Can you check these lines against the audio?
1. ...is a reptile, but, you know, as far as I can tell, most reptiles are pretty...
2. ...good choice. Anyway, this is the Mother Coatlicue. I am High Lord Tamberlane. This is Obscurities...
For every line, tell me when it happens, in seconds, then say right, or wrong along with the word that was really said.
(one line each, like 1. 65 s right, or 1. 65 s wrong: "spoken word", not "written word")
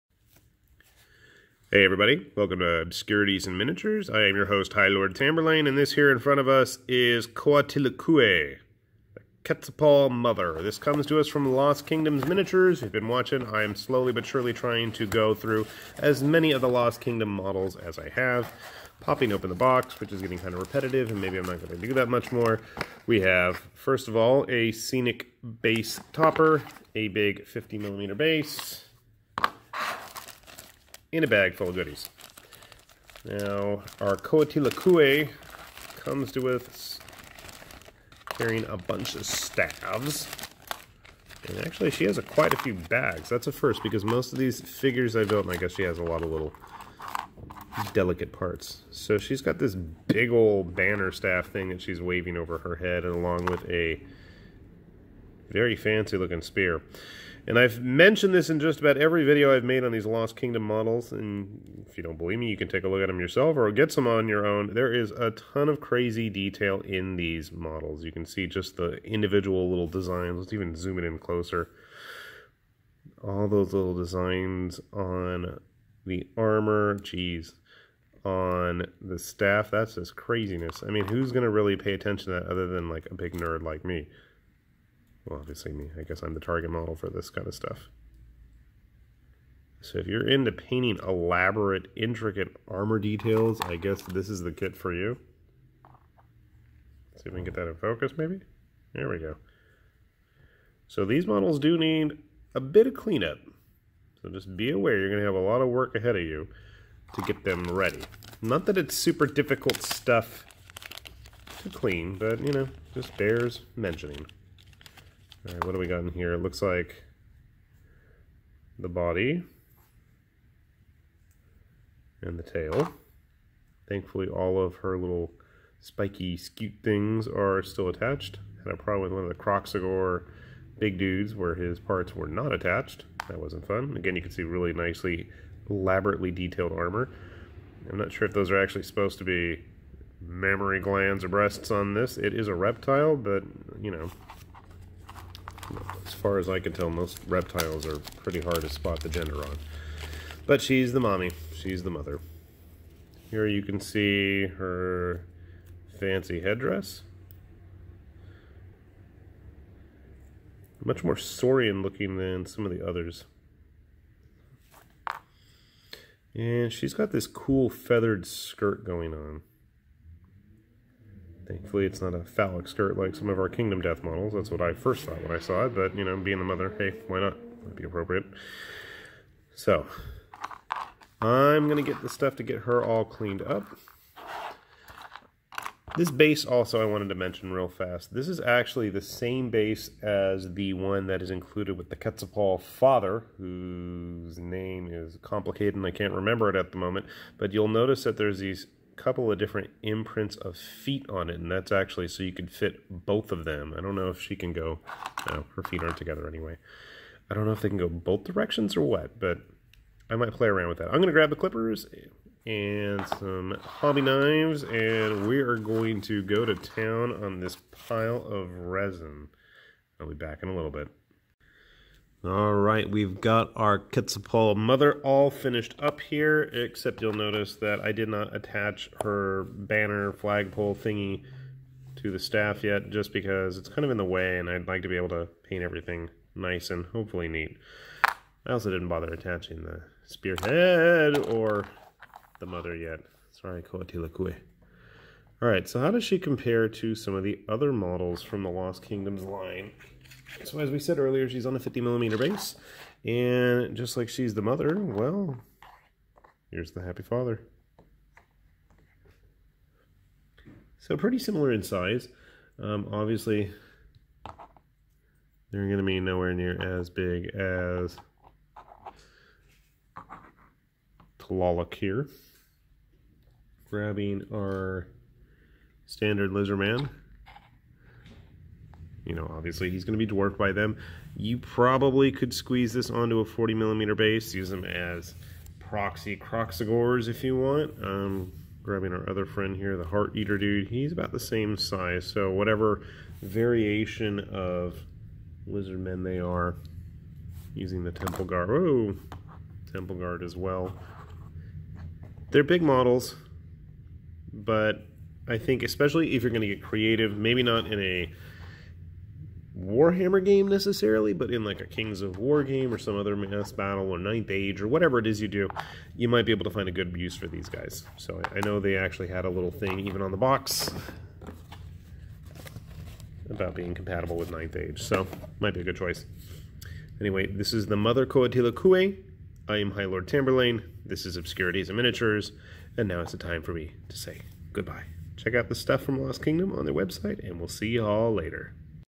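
1. 142 s right
2. 325 s right.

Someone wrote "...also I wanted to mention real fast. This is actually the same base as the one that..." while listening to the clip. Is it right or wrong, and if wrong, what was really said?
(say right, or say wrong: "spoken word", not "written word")
right.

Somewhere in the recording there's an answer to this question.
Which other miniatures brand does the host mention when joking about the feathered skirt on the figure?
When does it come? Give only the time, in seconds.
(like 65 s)
173 s.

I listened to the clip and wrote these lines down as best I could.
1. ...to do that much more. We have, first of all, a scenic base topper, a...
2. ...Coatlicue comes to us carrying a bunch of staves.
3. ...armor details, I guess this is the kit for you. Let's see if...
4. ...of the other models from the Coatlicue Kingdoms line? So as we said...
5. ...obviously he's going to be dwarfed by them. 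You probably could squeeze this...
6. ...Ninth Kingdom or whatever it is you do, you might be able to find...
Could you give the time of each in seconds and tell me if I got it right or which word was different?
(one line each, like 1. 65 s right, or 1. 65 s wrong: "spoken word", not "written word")
1. 21 s right
2. 34 s right
3. 92 s right
4. 247 s wrong: "Lost", not "Coatlicue"
5. 279 s right
6. 313 s wrong: "Age", not "Kingdom".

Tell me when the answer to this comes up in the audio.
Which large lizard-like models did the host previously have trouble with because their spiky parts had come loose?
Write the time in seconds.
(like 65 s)
129 s.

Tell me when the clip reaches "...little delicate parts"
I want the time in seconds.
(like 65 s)
46 s.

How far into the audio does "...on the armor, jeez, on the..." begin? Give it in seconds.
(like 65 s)
74 s.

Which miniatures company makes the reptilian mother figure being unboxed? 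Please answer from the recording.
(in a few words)
Lost Kingdoms Miniatures.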